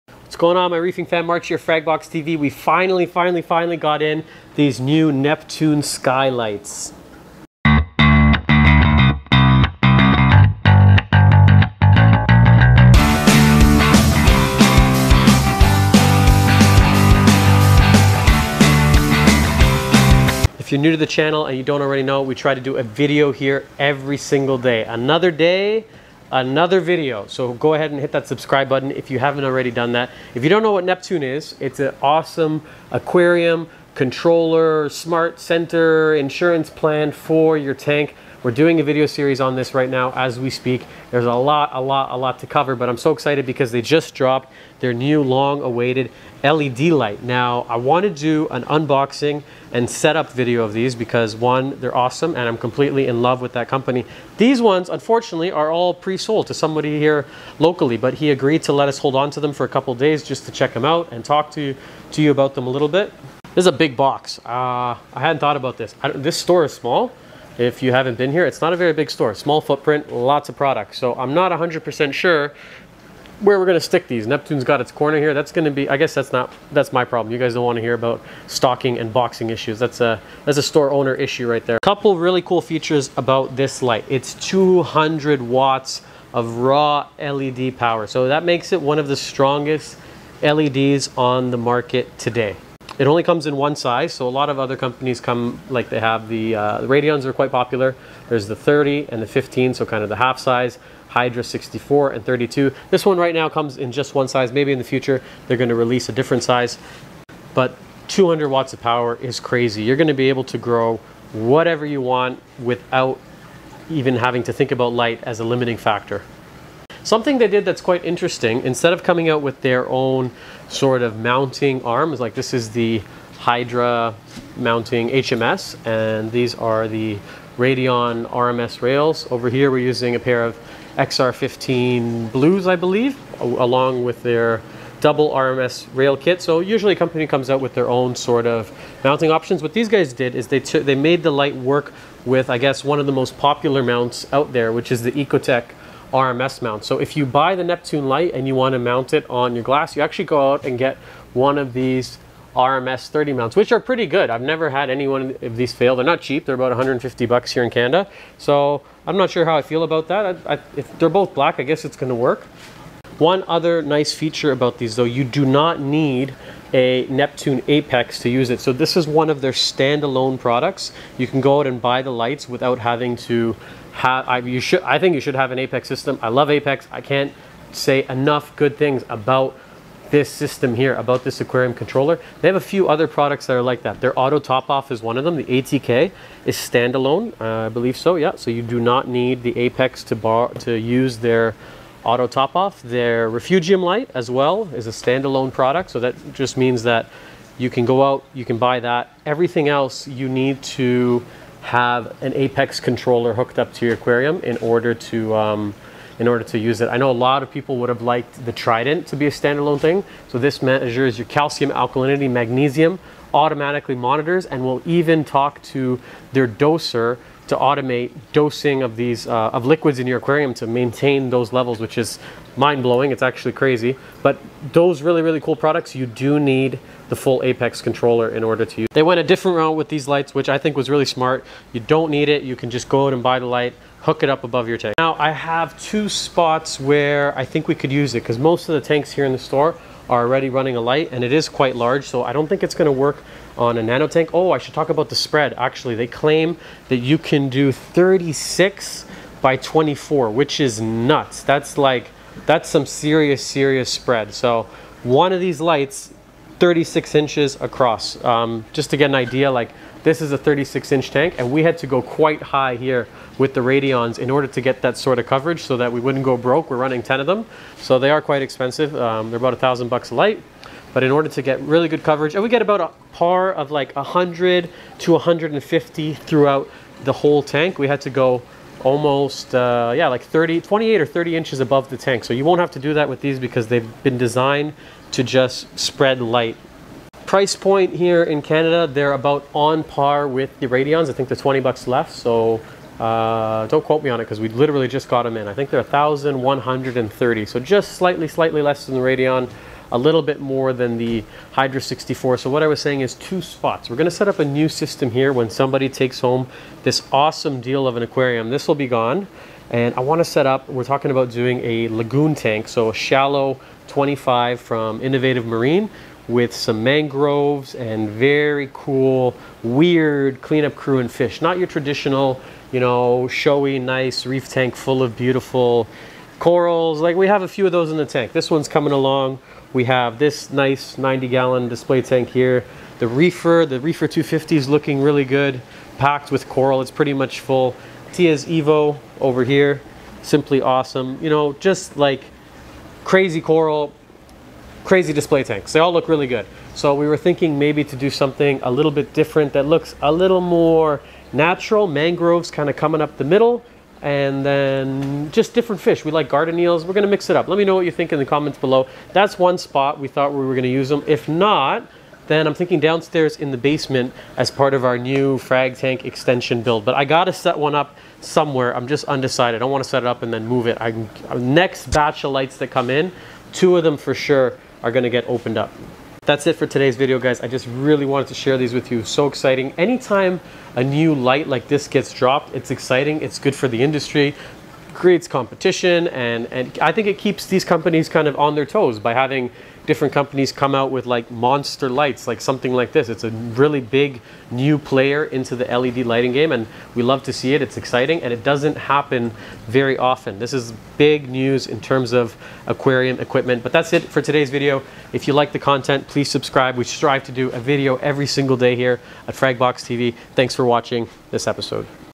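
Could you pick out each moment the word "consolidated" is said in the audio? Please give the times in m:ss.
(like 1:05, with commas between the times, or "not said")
not said.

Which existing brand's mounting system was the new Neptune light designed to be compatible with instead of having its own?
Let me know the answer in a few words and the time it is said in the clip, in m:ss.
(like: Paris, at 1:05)
Ecotech RMS, at 2:25.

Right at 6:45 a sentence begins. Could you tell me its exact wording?
If you like the content, please subscribe.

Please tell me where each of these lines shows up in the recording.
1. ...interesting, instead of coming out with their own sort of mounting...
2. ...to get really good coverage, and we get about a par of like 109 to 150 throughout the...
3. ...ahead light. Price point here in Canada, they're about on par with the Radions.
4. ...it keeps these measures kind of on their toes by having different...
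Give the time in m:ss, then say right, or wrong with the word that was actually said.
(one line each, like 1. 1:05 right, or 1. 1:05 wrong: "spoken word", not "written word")
1. 1:58 right
2. 4:31 wrong: "100", not "109"
3. 4:45 wrong: "spread", not "ahead"
4. 6:27 wrong: "companies", not "measures".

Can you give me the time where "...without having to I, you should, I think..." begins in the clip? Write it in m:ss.
2:52.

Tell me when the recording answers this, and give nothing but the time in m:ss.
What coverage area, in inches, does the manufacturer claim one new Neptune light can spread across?
4:07.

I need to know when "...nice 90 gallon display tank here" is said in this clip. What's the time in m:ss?
5:30.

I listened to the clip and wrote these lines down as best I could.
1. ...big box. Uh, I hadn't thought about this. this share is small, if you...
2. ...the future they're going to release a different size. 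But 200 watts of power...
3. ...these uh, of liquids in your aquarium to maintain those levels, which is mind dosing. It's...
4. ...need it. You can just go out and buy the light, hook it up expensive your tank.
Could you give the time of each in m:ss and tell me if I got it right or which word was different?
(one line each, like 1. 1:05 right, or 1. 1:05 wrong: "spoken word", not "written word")
1. 1:03 wrong: "store", not "share"
2. 1:44 right
3. 3:38 wrong: "blowing", not "dosing"
4. 3:52 wrong: "above", not "expensive".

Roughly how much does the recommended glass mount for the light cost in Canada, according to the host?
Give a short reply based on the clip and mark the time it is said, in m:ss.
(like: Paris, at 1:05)
150 bucks, at 2:36.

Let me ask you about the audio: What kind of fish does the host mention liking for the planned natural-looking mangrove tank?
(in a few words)
garden eels.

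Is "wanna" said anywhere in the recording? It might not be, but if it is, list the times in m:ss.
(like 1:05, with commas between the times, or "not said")
1:17, 5:09.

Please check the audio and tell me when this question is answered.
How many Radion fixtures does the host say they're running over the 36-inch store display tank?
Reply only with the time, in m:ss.
4:27.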